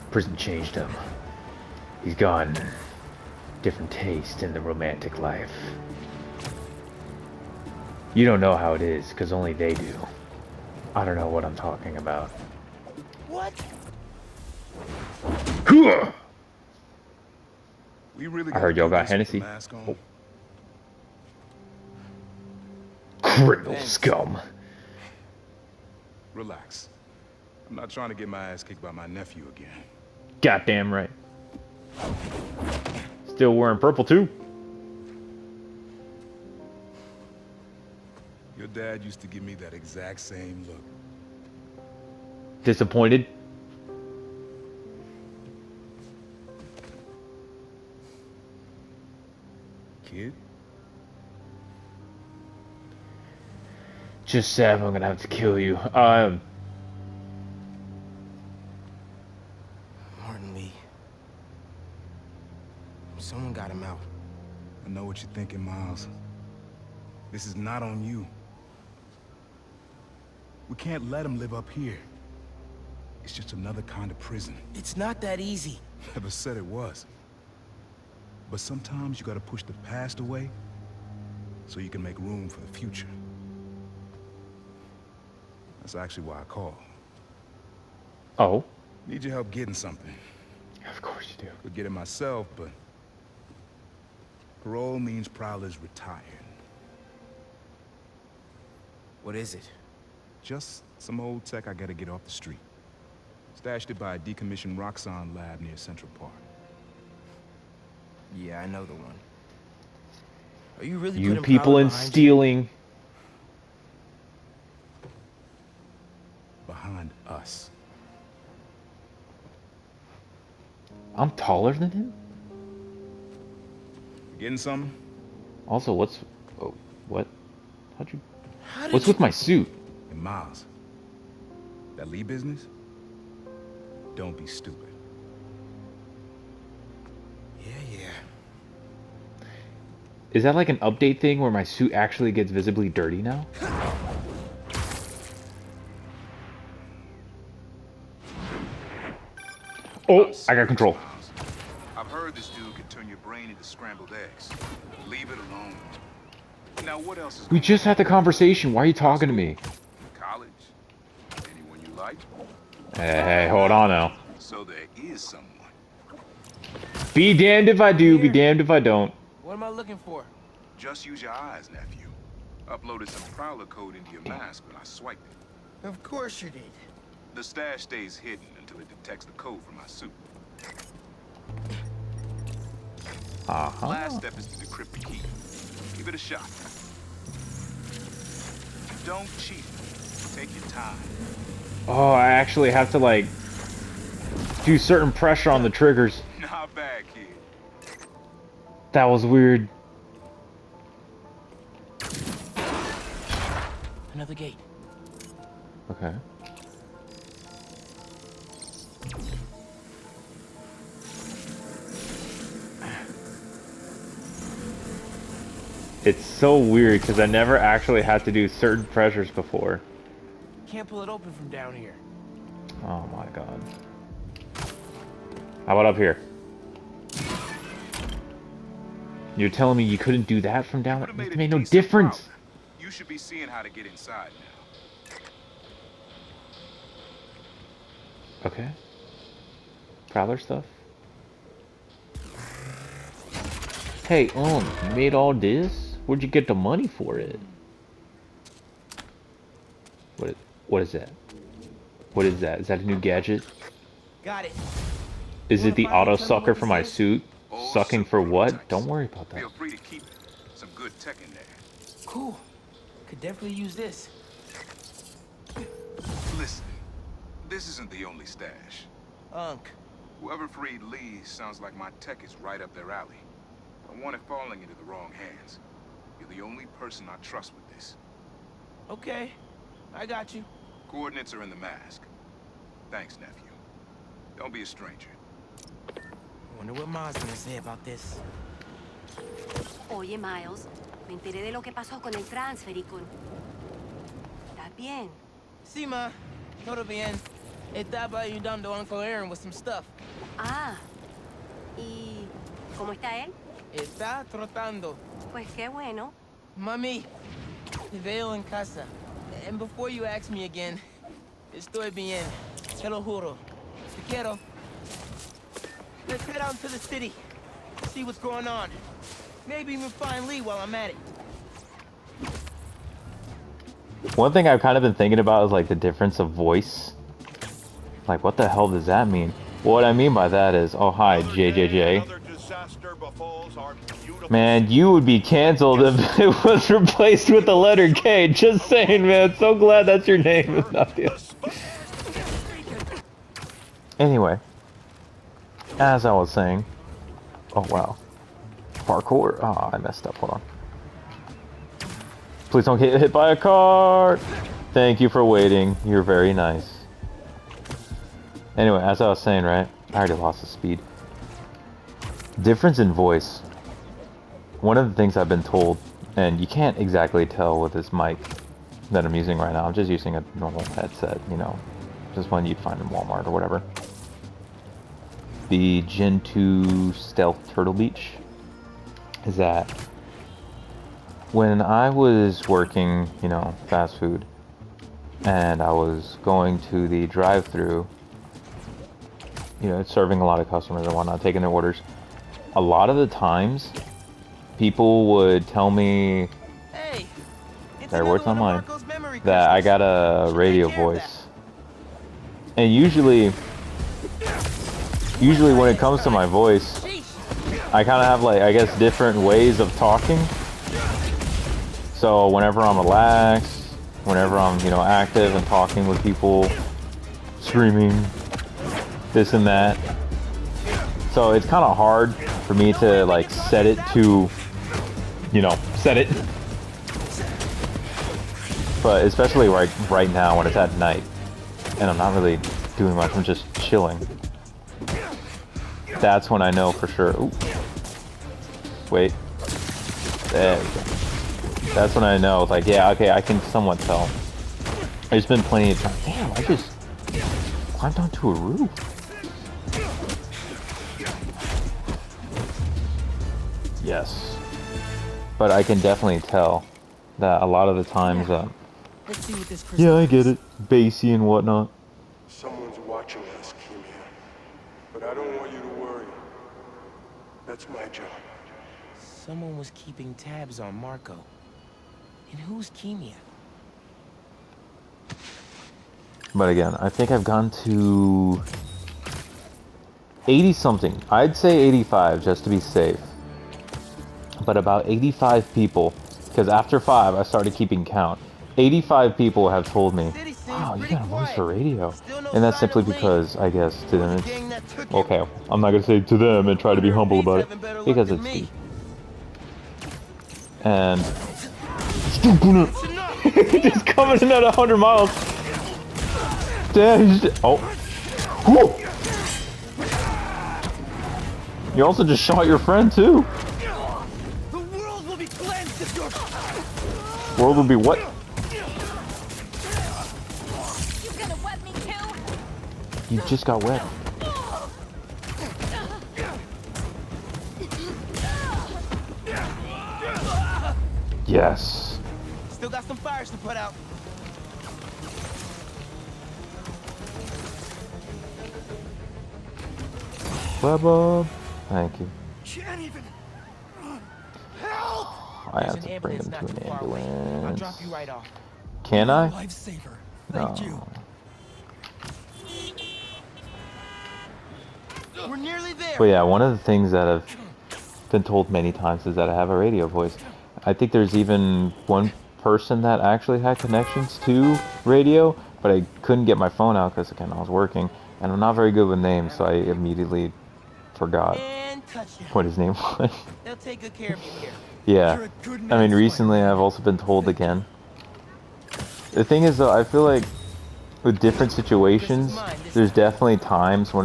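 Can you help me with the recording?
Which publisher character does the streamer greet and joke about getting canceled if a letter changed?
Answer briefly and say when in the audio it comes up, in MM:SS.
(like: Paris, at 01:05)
JJJ, at 05:31.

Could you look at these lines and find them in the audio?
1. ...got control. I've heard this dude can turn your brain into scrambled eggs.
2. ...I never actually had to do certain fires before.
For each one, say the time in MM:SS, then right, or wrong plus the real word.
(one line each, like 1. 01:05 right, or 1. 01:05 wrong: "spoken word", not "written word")
1. 02:30 right
2. 03:37 wrong: "pressures", not "fires".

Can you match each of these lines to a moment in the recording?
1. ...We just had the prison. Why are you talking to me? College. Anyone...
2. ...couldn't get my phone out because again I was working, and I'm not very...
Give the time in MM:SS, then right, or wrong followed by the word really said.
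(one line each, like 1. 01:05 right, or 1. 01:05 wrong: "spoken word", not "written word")
1. 02:37 wrong: "conversation", not "prison"
2. 09:26 right.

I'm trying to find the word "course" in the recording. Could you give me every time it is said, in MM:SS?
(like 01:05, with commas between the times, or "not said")
01:31, 02:56.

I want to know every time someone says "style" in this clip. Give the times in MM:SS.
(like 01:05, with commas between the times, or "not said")
not said.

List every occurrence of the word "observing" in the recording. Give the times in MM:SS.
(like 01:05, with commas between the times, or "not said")
not said.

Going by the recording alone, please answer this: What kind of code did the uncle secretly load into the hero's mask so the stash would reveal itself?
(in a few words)
Prowler code.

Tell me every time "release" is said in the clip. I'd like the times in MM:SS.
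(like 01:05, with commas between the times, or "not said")
not said.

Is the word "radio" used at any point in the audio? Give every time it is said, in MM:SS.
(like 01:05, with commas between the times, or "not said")
06:40, 08:11, 09:19, 09:24.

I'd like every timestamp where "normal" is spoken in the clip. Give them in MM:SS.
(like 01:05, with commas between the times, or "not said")
06:10.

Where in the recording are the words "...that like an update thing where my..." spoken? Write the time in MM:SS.
02:20.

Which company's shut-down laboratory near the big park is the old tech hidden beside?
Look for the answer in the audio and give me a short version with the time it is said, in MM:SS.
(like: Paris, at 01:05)
Roxxon, at 01:44.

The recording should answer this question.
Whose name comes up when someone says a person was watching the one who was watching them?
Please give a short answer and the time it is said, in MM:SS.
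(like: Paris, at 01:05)
Marco, at 07:50.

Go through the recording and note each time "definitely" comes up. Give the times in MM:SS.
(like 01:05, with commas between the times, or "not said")
04:23, 07:35, 09:42.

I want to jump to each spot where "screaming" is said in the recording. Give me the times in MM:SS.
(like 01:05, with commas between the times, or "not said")
06:57.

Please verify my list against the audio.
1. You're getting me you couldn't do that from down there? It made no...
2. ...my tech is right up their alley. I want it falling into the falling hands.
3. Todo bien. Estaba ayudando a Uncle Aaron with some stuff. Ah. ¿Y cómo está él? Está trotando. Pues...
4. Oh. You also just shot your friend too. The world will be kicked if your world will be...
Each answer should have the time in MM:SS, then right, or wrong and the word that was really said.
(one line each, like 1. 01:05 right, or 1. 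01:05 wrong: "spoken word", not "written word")
1. 03:49 wrong: "telling", not "getting"
2. 04:31 wrong: "wrong", not "falling"
3. 04:56 right
4. 08:27 wrong: "cleansed", not "kicked".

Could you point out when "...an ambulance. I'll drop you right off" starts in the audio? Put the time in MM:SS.
09:06.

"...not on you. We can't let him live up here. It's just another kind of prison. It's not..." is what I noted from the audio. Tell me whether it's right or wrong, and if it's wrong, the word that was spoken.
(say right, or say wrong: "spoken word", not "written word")
right.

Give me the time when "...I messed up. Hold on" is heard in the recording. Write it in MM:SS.
05:49.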